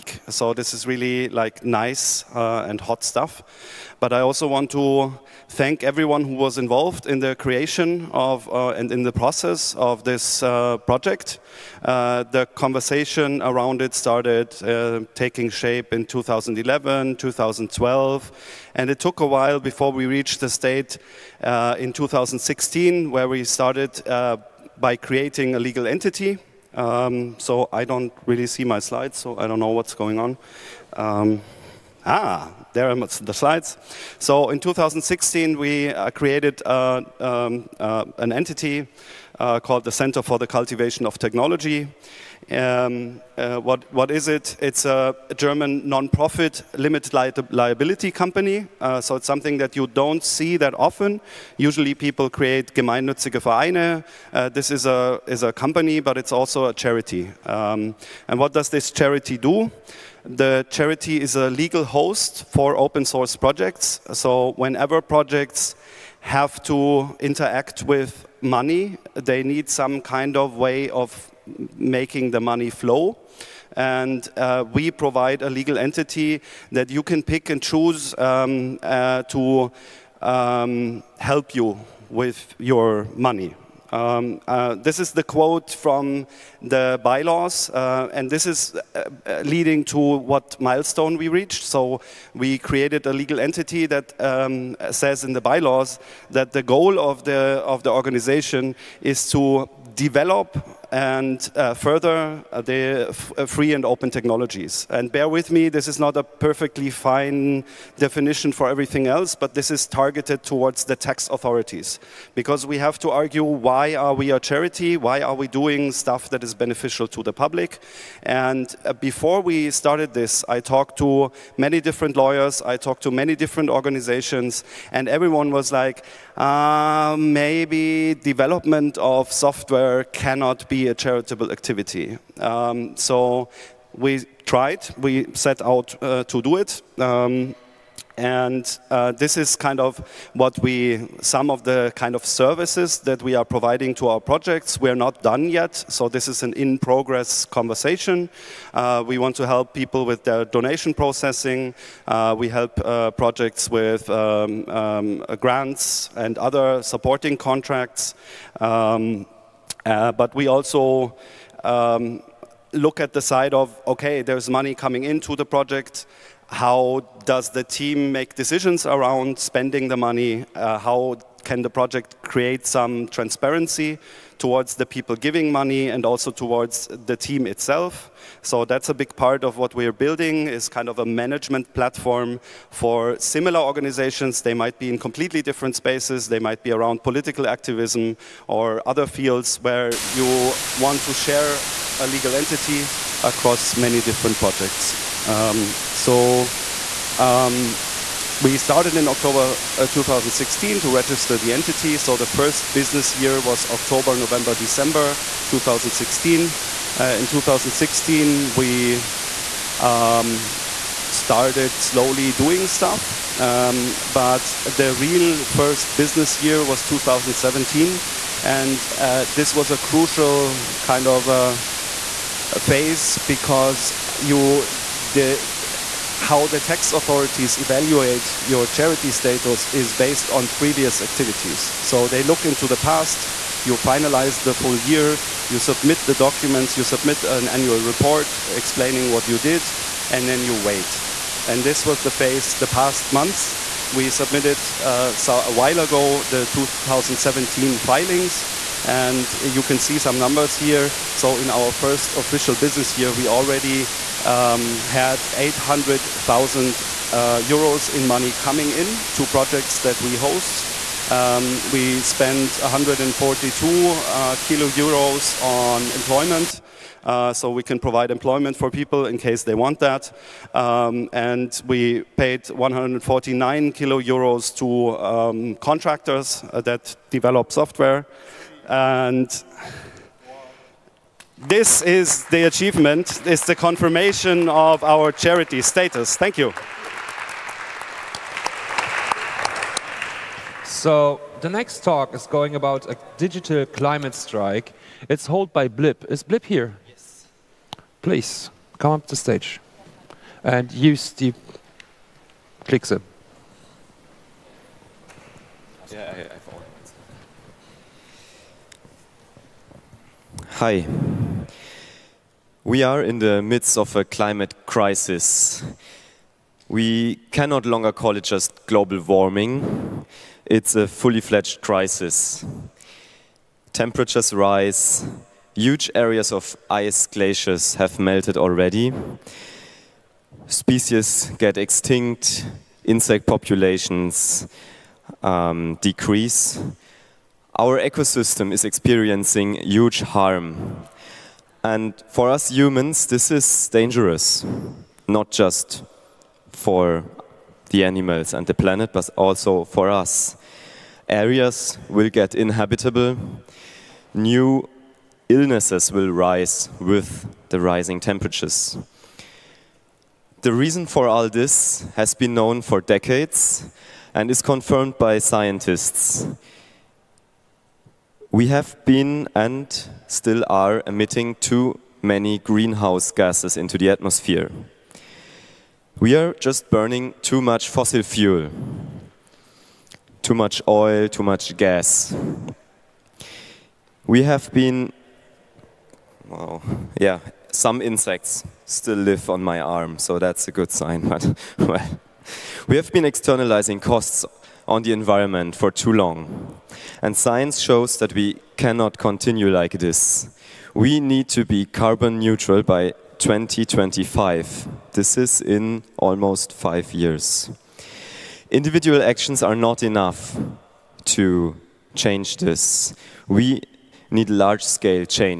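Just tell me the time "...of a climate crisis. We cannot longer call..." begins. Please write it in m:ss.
5:13.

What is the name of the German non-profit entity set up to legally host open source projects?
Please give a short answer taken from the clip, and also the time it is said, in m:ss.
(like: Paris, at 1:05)
Center for the Cultivation of Technology, at 0:39.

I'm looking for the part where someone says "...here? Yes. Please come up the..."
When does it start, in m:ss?
4:56.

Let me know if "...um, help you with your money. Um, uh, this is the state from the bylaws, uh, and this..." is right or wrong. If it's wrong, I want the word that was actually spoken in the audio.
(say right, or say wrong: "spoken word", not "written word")
wrong: "quote", not "state".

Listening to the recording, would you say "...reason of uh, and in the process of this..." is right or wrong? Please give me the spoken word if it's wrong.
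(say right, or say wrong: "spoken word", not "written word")
wrong: "creation", not "reason".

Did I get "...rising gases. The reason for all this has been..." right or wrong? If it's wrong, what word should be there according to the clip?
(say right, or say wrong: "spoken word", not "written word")
wrong: "temperatures", not "gases".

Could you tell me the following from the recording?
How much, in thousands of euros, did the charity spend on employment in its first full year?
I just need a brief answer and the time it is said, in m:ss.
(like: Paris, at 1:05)
142, at 4:22.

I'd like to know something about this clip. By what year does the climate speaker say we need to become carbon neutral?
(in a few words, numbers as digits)
2025.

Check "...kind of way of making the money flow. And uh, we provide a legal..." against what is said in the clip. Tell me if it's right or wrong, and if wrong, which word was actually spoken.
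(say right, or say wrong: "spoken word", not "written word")
right.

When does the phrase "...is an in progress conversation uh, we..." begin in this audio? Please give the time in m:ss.
2:26.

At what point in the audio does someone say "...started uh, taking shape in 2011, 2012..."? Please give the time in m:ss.
0:13.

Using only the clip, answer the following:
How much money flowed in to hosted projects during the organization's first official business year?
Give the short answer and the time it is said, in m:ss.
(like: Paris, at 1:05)
800,000 euros, at 4:15.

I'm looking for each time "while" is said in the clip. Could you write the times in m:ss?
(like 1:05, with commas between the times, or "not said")
0:19, 4:05.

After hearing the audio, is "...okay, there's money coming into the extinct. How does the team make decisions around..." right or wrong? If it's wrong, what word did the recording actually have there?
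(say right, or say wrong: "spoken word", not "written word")
wrong: "project", not "extinct".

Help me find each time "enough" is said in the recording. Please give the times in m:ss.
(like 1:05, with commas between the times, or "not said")
6:49.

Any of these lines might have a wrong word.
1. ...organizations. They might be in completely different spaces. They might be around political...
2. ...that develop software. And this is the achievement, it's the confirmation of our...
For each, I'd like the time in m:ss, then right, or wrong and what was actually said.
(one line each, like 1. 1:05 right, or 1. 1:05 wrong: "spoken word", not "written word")
1. 3:03 right
2. 4:36 right.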